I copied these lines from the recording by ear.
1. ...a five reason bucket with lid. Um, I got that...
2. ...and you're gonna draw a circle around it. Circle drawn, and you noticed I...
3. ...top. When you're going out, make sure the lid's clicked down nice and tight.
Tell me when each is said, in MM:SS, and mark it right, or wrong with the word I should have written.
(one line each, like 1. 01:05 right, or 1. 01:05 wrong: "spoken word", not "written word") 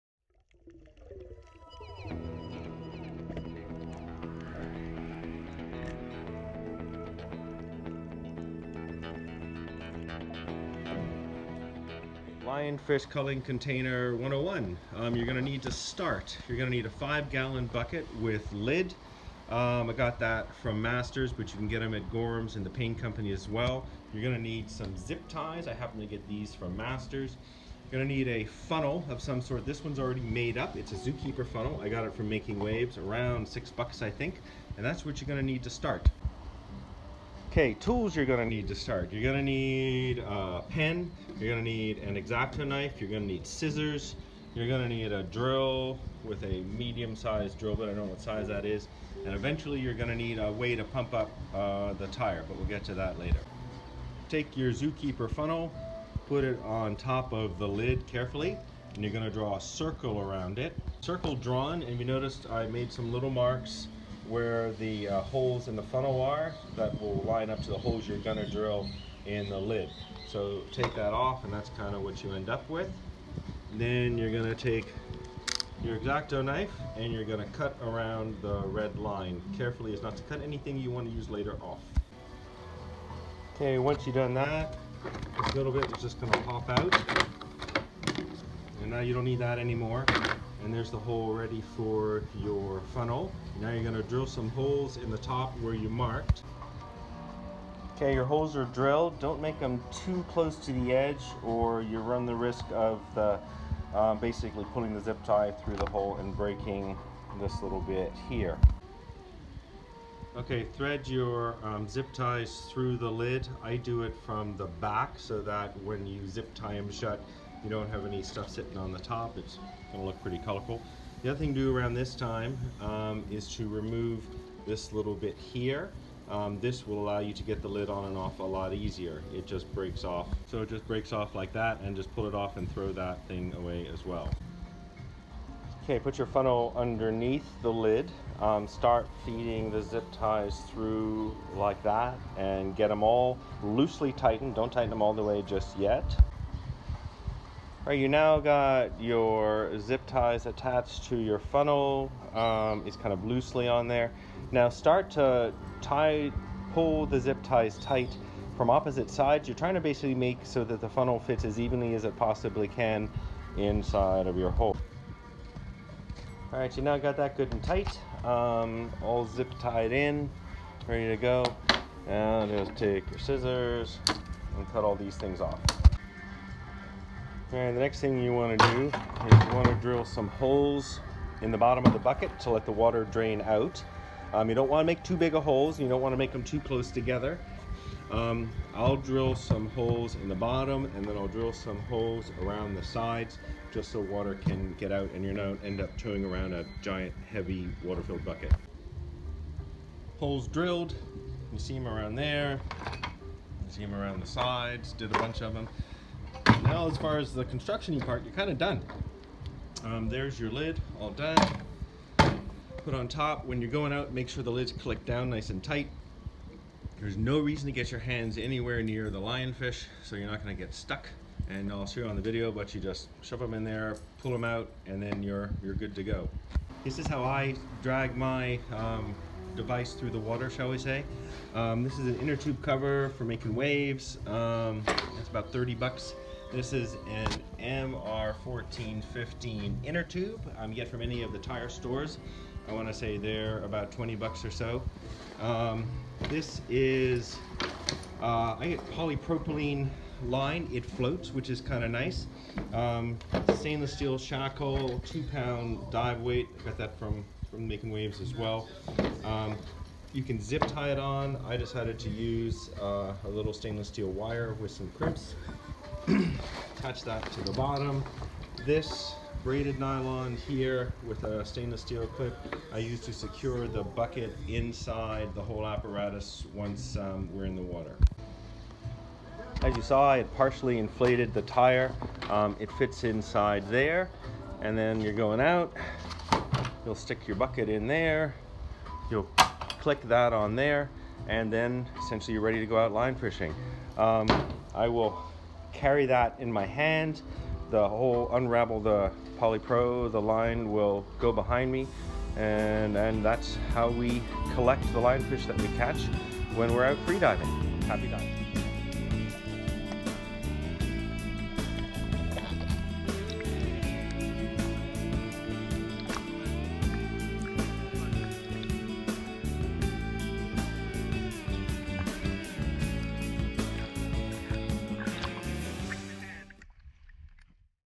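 1. 00:16 wrong: "gallon", not "reason"
2. 00:58 right
3. 03:33 right.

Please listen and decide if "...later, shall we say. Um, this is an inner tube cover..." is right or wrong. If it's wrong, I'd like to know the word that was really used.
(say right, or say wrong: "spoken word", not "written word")
wrong: "water", not "later".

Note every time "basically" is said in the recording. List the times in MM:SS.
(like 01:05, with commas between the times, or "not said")
01:44, 02:39.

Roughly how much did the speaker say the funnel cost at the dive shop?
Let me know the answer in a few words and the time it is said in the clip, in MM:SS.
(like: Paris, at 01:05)
$6, at 00:33.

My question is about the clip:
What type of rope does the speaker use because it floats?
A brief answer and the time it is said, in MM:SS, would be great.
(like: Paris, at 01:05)
Polypropylene line, at 04:08.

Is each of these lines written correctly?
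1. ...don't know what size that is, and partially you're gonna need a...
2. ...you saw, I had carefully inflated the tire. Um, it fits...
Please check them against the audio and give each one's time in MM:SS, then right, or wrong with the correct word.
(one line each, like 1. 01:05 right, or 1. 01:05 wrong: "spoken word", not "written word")
1. 00:47 wrong: "eventually", not "partially"
2. 04:39 wrong: "partially", not "carefully".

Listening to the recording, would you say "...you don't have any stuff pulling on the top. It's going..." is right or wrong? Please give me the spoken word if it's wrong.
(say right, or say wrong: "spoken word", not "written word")
wrong: "sitting", not "pulling".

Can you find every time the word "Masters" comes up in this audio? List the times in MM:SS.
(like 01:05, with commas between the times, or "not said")
00:20, 00:26.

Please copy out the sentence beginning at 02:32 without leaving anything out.
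Um, it's kind of loosely on there.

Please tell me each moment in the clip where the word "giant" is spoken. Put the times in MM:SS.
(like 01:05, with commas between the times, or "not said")
03:16.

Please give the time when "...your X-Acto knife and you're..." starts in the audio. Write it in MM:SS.
01:15.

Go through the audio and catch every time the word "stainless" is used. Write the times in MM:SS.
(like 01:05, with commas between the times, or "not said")
04:13, 04:23, 04:31.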